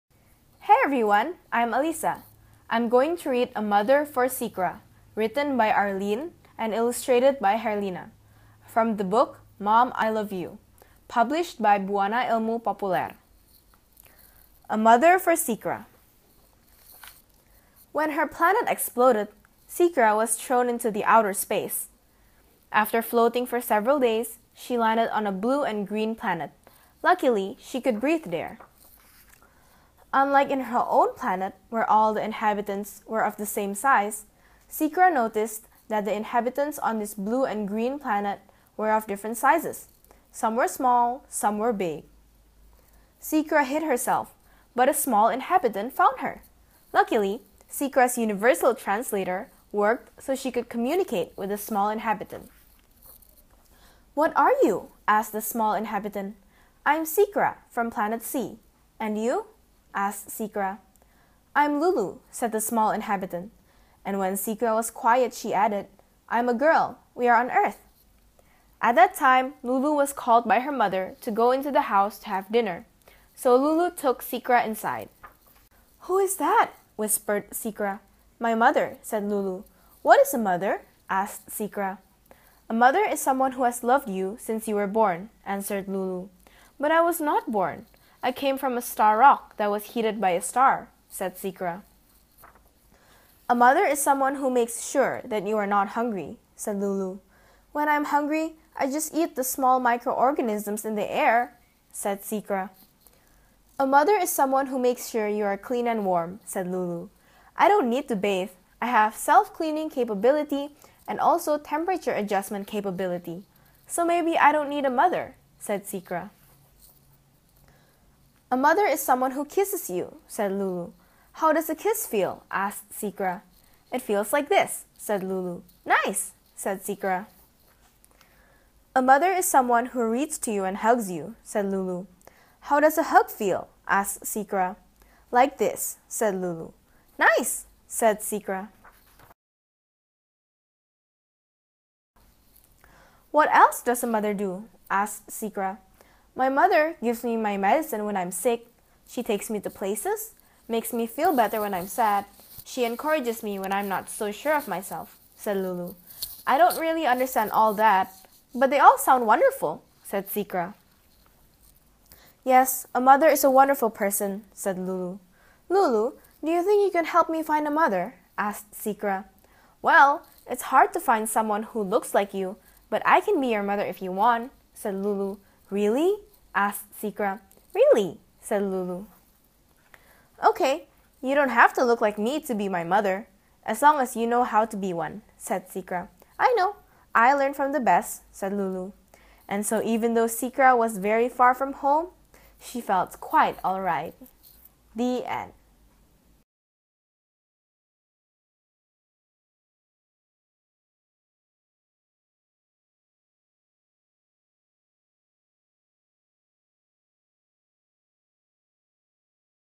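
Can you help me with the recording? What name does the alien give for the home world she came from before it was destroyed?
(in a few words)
Planet C.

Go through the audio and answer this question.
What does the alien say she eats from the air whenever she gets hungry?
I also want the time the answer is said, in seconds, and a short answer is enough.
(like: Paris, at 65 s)
Small microorganisms, at 99 s.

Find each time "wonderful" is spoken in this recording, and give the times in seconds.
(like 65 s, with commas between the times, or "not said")
159 s, 163 s.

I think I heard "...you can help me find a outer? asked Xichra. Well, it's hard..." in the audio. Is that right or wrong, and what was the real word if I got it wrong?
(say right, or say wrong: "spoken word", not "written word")
wrong: "mother", not "outer".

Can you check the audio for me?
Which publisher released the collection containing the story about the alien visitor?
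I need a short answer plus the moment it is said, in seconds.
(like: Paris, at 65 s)
Bhuana Ilmu Populer, at 11 s.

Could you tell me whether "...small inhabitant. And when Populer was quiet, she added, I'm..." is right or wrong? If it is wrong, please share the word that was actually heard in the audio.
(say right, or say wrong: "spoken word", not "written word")
wrong: "Xichra", not "Populer".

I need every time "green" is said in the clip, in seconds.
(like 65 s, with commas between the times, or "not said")
25 s, 37 s.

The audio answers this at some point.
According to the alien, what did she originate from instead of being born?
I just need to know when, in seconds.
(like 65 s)
88 s.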